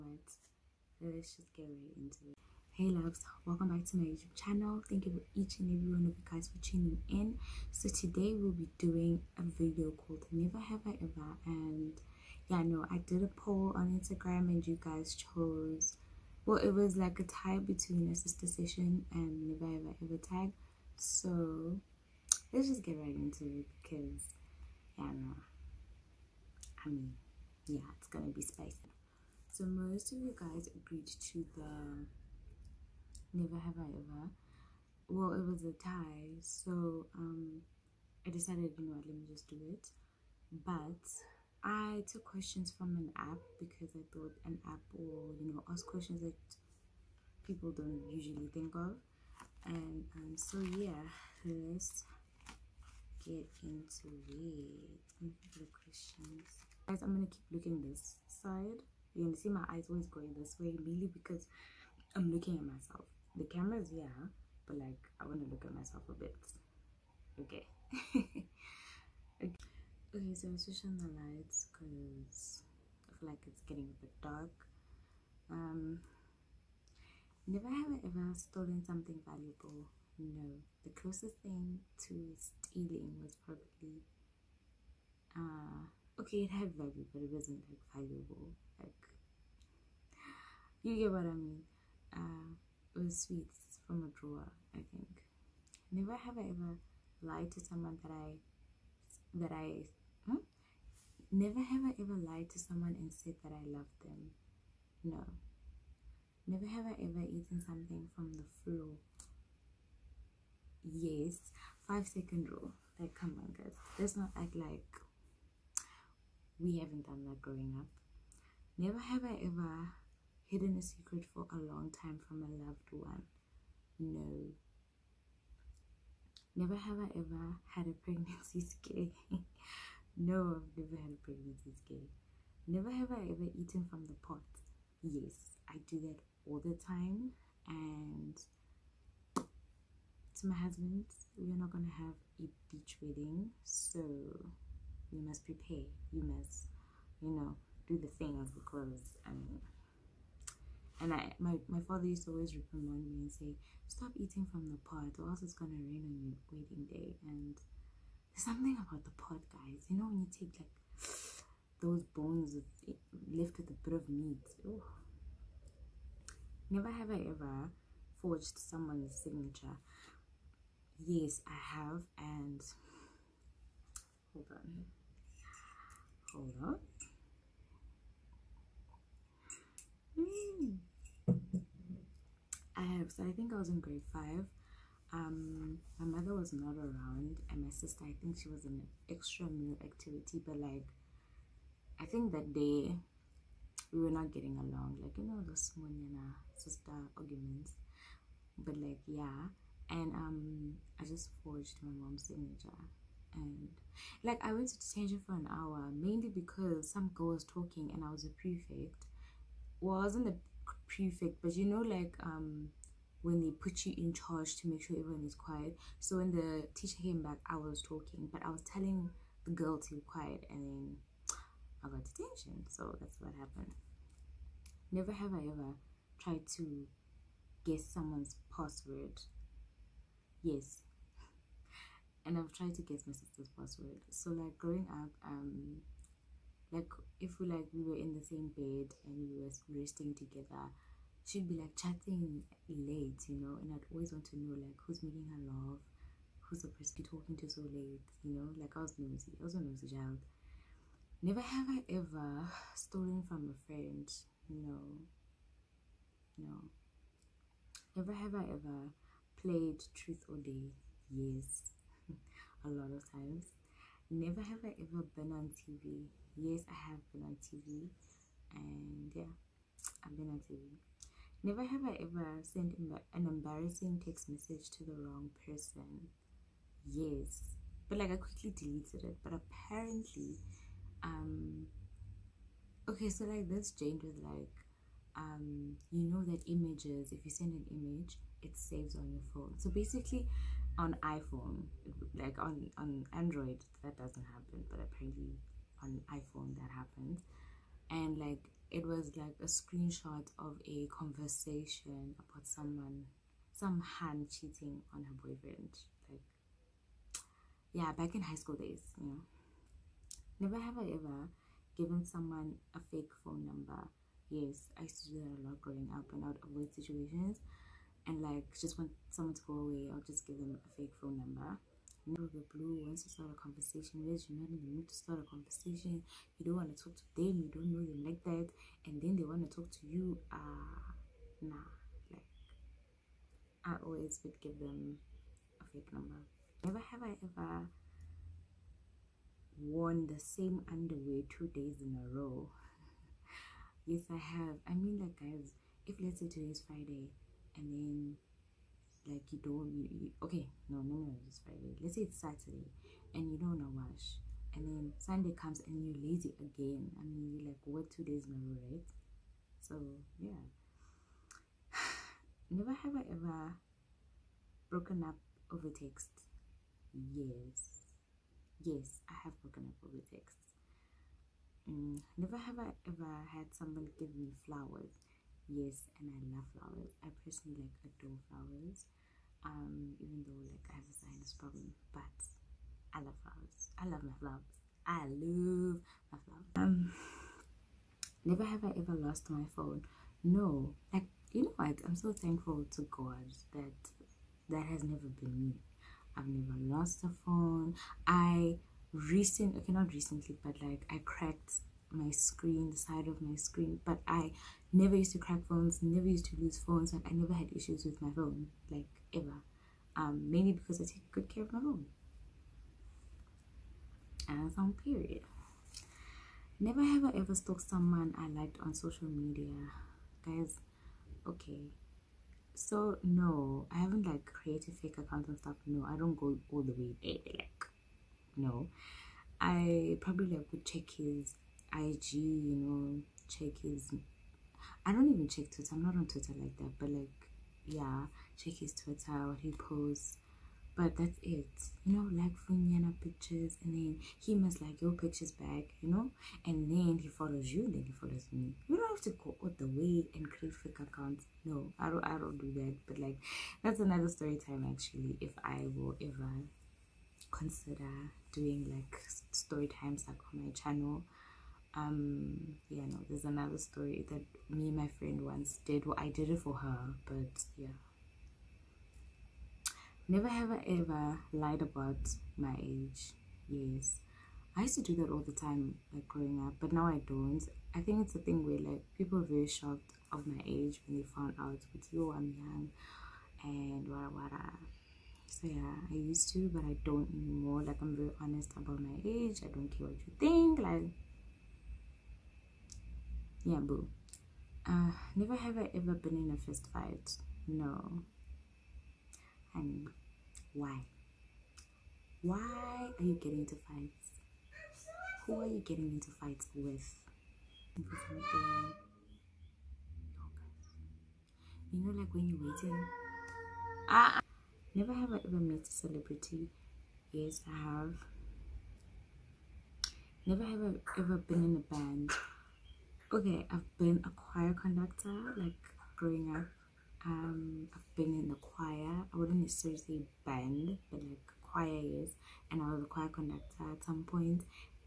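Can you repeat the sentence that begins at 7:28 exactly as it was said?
You don't have to go all the way and create fake accounts.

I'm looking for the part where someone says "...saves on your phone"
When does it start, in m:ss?
4:48.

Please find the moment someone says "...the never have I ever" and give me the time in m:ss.
0:31.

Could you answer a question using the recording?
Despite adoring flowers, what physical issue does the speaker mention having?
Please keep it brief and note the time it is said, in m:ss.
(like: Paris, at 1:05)
A sinus problem, at 6:20.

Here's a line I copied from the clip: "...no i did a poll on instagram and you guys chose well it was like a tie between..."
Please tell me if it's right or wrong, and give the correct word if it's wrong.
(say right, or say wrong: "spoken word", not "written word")
right.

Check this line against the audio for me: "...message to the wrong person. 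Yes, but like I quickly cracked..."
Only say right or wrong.
wrong.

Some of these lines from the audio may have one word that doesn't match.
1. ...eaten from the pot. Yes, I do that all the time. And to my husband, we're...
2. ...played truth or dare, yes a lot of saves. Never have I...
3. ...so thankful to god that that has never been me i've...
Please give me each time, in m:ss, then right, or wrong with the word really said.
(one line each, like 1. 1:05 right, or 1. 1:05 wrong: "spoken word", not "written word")
1. 2:13 right
2. 4:19 wrong: "times", not "saves"
3. 6:31 right.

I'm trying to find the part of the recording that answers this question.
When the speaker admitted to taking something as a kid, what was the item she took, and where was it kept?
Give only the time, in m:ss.
1:33.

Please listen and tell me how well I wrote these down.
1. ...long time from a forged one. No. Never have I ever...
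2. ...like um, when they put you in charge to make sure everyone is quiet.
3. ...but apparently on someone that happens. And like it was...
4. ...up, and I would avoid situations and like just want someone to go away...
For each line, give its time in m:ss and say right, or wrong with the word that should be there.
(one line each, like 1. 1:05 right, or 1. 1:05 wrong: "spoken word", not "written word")
1. 2:01 wrong: "loved", not "forged"
2. 3:31 right
3. 4:54 wrong: "iPhone", not "someone"
4. 5:15 right.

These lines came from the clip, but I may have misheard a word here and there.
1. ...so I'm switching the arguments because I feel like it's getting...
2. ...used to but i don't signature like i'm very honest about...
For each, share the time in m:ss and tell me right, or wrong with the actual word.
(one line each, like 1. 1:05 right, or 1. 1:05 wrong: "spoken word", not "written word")
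1. 1:10 wrong: "lights", not "arguments"
2. 8:05 wrong: "anymore", not "signature".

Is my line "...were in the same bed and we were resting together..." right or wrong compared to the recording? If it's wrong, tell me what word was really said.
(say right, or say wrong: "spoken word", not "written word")
right.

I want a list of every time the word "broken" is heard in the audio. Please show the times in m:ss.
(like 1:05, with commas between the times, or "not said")
6:04, 6:09.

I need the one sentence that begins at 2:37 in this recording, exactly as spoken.
And there's something about the pot, guys.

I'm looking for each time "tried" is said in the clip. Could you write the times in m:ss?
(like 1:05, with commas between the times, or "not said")
3:46, 3:52.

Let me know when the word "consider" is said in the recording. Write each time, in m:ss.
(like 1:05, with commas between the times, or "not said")
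7:37.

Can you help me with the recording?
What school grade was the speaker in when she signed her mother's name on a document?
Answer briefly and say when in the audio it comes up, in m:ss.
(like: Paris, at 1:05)
Grade 5, at 3:03.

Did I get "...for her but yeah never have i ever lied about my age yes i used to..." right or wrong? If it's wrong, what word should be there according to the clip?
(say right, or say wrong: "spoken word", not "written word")
right.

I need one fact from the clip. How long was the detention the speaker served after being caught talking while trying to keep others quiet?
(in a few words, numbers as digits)
An hour.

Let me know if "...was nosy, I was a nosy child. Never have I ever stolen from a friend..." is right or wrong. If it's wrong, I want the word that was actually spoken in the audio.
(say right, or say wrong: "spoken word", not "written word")
right.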